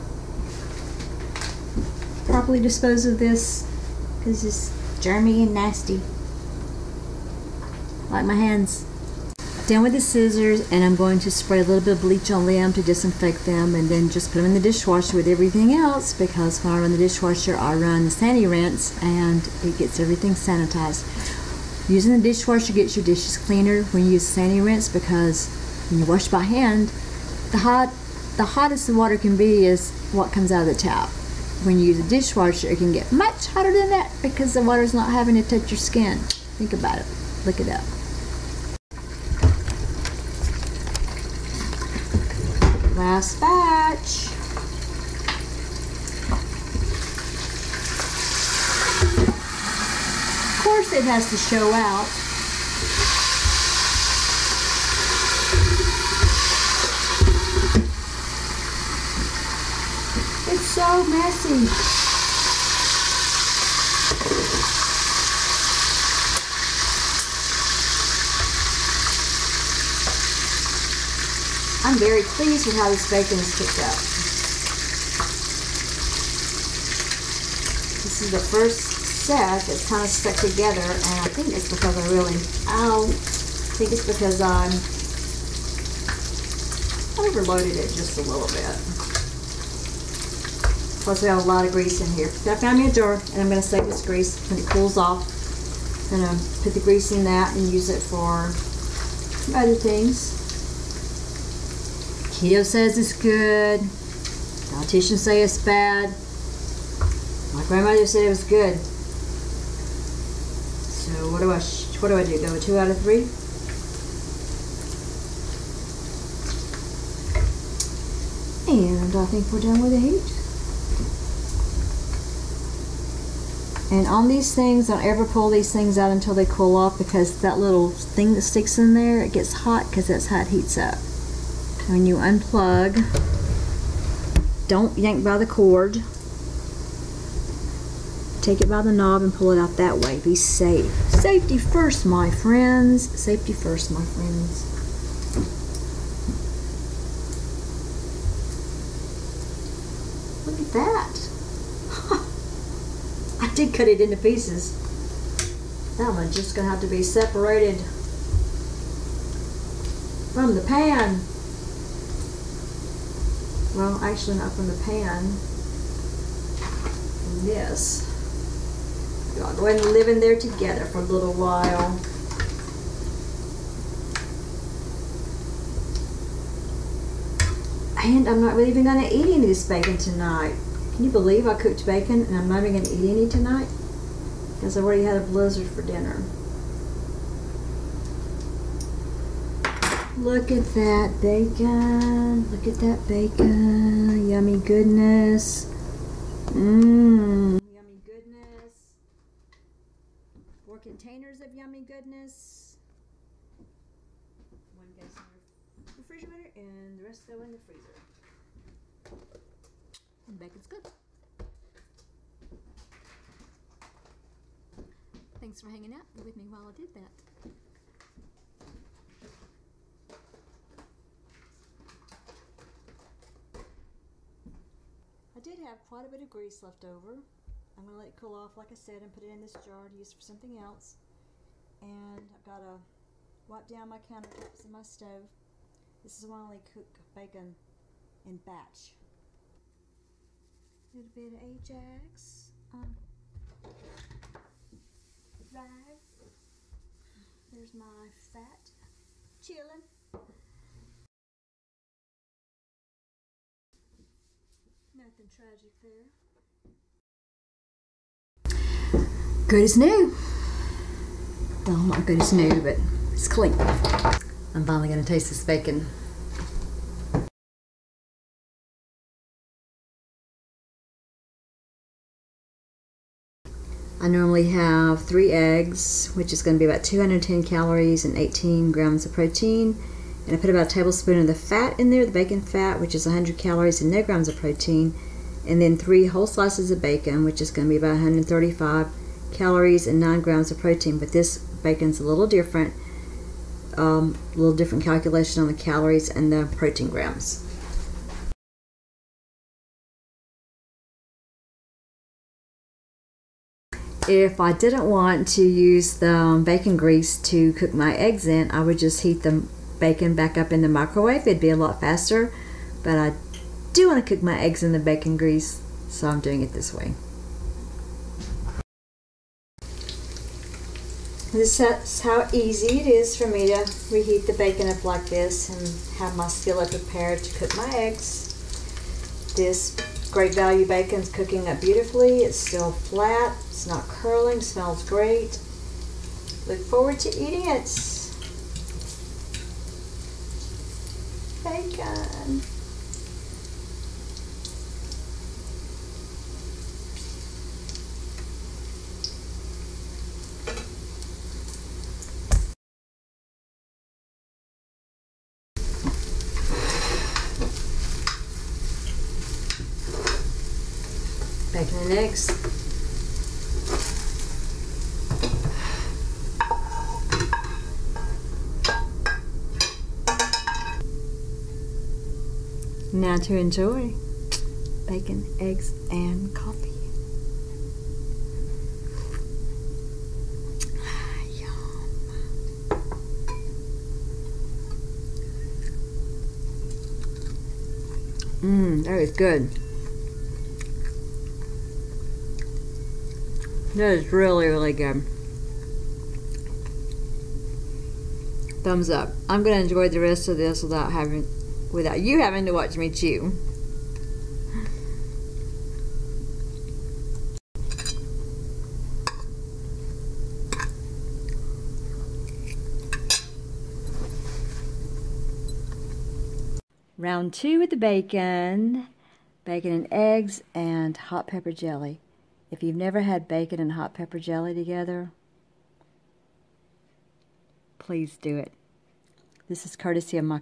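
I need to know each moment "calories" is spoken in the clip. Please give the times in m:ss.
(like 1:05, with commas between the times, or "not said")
4:37, 4:43, 4:49, 4:55.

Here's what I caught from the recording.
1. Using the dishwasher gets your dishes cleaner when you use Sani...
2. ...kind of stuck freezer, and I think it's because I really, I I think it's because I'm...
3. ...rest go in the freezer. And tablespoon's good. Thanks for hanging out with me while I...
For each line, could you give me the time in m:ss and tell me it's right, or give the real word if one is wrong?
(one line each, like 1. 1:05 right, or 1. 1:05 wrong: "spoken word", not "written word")
1. 0:21 right
2. 1:19 wrong: "together", not "freezer"
3. 3:27 wrong: "bacon", not "tablespoon".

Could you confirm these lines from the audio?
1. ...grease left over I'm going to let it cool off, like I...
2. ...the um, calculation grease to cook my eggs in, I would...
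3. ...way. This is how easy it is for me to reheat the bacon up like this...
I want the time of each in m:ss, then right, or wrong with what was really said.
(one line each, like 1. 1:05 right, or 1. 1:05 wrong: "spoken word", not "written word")
1. 3:46 right
2. 5:05 wrong: "bacon", not "calculation"
3. 5:16 right.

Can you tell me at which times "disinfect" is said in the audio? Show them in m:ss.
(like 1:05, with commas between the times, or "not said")
0:12.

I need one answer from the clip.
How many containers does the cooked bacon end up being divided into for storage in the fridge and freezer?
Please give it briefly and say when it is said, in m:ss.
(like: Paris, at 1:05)
4, at 3:20.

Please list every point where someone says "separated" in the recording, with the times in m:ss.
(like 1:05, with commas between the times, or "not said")
2:37.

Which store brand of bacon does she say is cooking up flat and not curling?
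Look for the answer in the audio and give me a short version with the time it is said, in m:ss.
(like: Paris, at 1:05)
Great Value, at 5:30.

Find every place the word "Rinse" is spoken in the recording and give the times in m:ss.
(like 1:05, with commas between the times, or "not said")
0:18, 0:24.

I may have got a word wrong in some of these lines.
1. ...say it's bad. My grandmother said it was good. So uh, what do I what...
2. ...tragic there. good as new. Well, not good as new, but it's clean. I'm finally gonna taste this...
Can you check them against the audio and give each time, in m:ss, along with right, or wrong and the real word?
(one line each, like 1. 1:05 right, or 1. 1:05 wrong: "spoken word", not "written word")
1. 1:45 right
2. 4:15 right.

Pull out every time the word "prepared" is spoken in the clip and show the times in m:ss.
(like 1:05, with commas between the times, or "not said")
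5:26.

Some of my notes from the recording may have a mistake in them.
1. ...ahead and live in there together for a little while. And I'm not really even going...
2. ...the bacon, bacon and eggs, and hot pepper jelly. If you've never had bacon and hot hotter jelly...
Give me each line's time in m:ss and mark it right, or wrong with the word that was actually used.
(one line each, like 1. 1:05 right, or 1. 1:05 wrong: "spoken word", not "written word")
1. 2:49 right
2. 6:57 wrong: "pepper", not "hotter".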